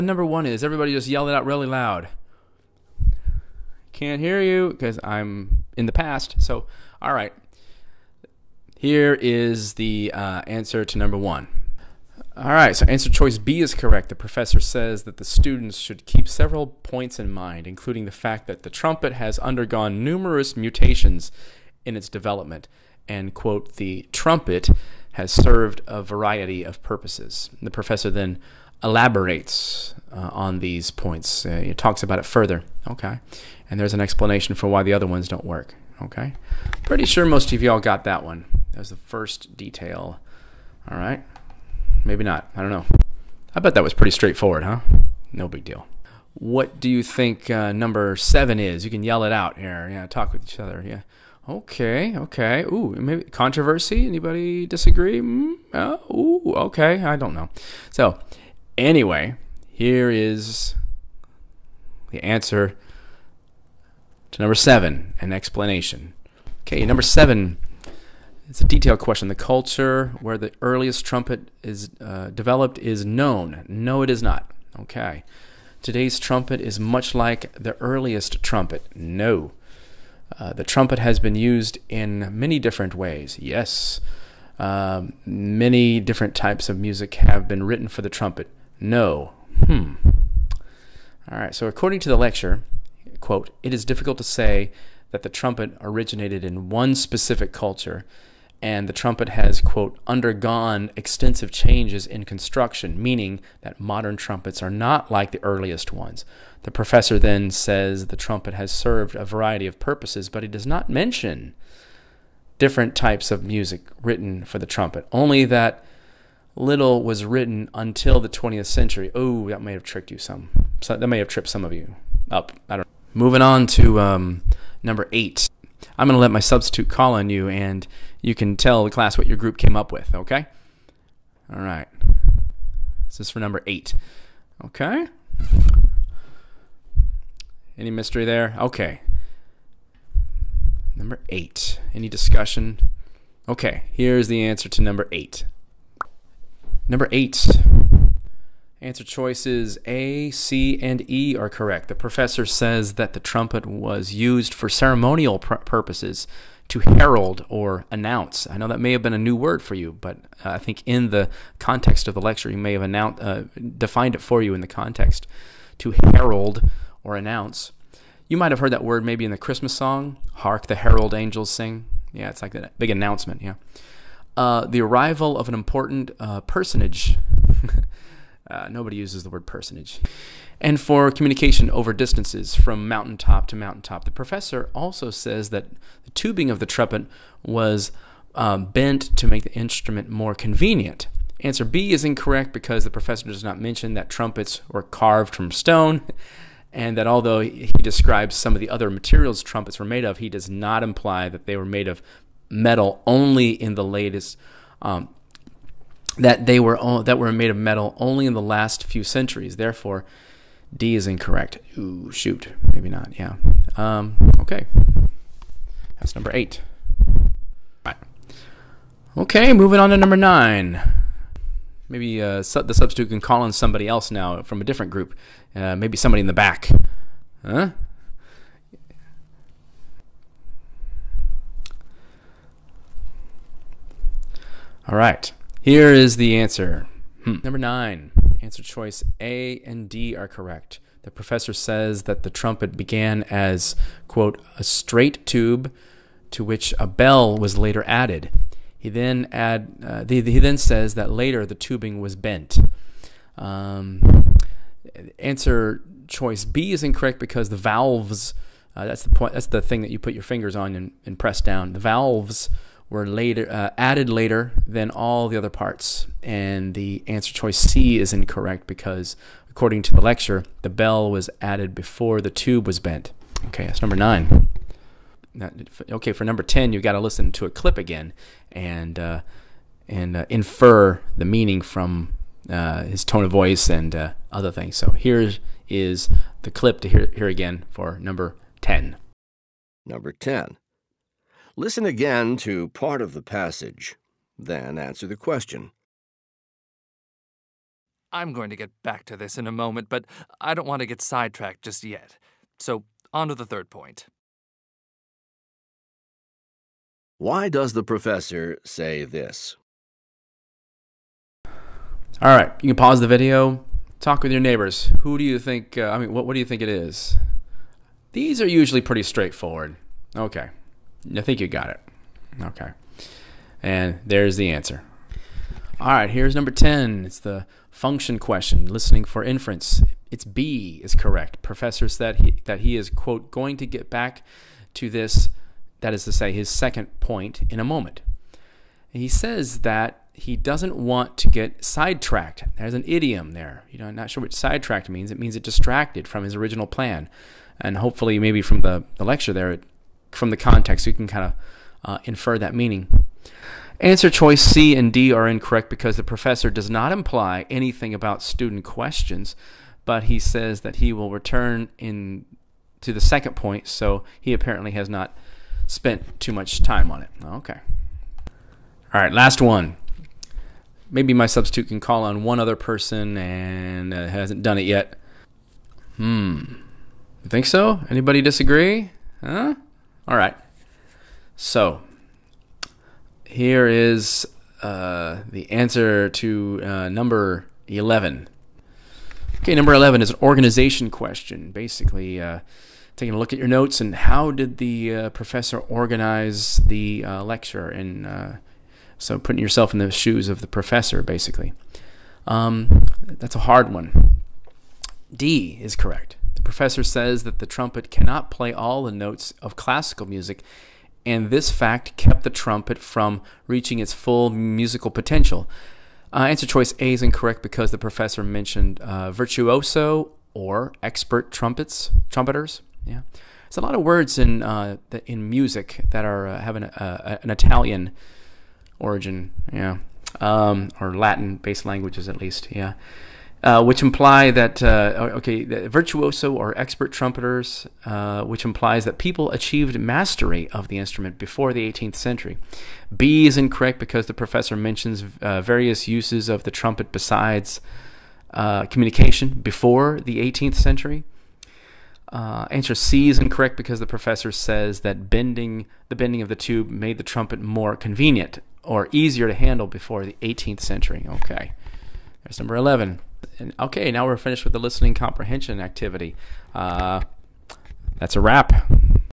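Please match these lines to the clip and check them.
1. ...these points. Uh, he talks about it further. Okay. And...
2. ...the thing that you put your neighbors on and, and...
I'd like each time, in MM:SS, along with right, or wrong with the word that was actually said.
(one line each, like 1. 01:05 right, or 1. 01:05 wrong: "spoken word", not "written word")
1. 00:30 right
2. 04:19 wrong: "fingers", not "neighbors".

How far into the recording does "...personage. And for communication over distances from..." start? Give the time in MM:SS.
02:59.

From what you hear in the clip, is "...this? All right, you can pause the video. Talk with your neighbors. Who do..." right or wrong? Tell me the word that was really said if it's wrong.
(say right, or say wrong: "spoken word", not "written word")
right.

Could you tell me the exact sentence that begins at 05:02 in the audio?
So, on to the third point.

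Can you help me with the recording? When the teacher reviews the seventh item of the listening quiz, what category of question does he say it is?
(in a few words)
detailed question.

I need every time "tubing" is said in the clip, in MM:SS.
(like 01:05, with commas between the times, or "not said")
03:06, 04:11.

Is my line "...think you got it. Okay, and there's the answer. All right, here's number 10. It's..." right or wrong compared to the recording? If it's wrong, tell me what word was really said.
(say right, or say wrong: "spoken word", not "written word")
right.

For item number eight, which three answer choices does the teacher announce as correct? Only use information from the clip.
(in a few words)
A, C, and E.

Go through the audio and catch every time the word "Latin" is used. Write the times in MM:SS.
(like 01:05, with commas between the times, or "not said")
07:10.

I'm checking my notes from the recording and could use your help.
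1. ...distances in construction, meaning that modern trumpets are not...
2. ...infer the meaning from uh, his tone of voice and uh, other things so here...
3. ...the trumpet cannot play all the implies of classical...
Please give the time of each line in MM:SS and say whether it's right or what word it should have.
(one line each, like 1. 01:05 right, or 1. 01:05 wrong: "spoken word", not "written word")
1. 01:41 wrong: "changes", not "distances"
2. 04:40 right
3. 06:47 wrong: "notes", not "implies".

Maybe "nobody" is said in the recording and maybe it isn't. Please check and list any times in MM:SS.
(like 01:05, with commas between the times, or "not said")
02:58.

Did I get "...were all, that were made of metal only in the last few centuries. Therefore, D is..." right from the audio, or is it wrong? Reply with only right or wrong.
right.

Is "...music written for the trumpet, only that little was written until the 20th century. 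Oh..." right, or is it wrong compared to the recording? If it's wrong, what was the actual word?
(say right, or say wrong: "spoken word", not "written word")
right.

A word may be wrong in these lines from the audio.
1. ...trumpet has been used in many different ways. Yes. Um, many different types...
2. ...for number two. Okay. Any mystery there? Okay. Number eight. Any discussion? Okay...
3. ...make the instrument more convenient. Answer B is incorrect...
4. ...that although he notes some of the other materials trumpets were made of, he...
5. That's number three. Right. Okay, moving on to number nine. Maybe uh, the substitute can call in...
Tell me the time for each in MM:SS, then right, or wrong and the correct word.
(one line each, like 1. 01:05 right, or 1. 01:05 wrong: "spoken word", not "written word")
1. 01:20 right
2. 02:13 wrong: "eight", not "two"
3. 03:09 right
4. 03:16 wrong: "describes", not "notes"
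5. 03:35 wrong: "eight", not "three".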